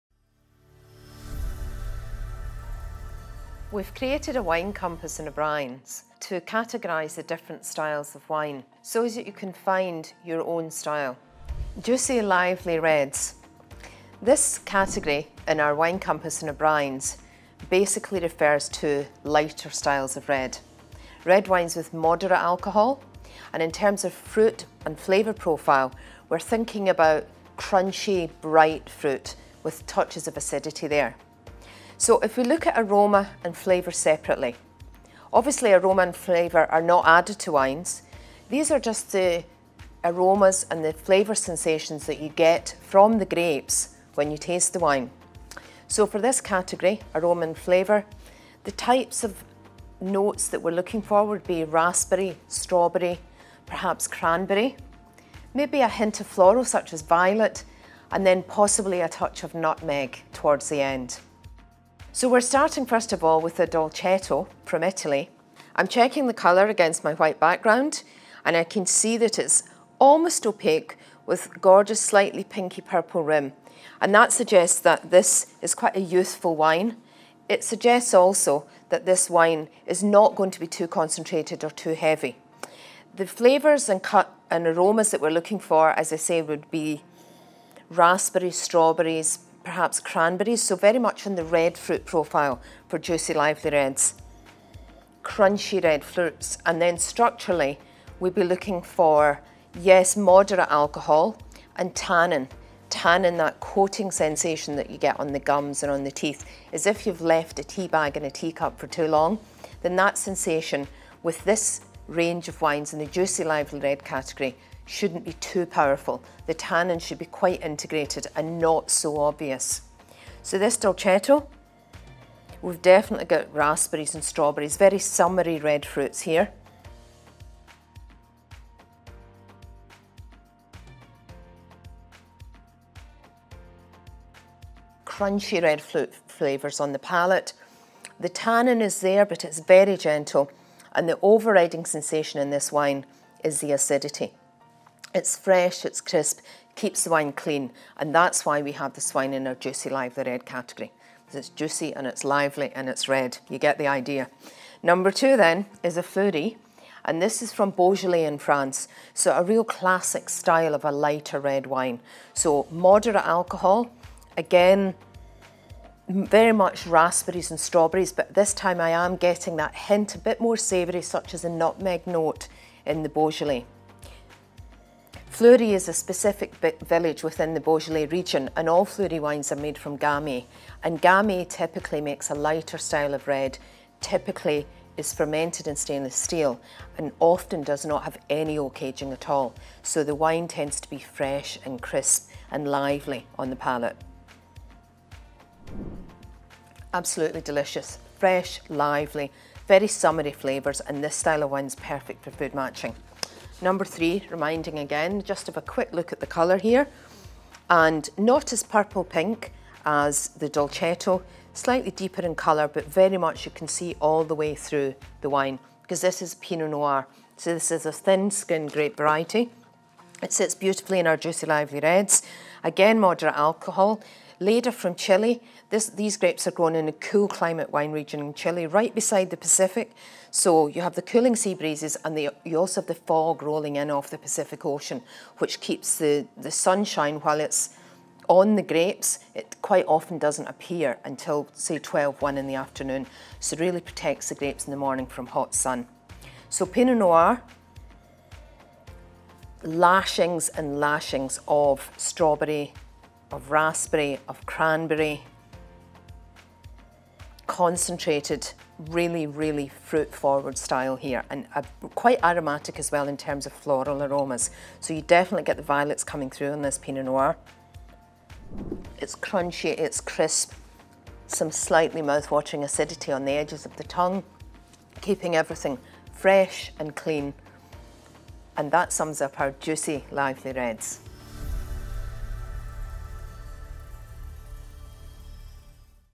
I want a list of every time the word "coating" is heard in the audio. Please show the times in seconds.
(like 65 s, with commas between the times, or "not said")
103 s.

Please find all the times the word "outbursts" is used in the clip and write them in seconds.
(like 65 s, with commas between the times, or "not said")
not said.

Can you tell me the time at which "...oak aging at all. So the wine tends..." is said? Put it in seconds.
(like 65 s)
188 s.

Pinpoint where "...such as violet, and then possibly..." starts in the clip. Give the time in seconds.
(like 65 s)
56 s.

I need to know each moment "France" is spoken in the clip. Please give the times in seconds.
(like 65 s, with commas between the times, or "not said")
158 s.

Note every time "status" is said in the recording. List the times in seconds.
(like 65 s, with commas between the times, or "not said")
not said.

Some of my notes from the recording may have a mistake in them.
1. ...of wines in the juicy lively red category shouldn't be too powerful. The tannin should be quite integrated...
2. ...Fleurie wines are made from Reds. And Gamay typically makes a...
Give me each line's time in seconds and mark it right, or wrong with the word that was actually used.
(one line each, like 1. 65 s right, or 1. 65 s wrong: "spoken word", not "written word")
1. 112 s right
2. 178 s wrong: "Gamay", not "Reds".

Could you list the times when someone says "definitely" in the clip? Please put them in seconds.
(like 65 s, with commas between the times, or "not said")
122 s, 265 s.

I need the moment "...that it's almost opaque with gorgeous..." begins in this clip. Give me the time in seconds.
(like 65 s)
69 s.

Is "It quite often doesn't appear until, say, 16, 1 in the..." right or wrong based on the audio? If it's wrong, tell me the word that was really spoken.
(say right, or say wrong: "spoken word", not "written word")
wrong: "12", not "16".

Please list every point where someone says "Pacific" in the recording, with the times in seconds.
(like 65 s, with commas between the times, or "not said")
229 s, 234 s.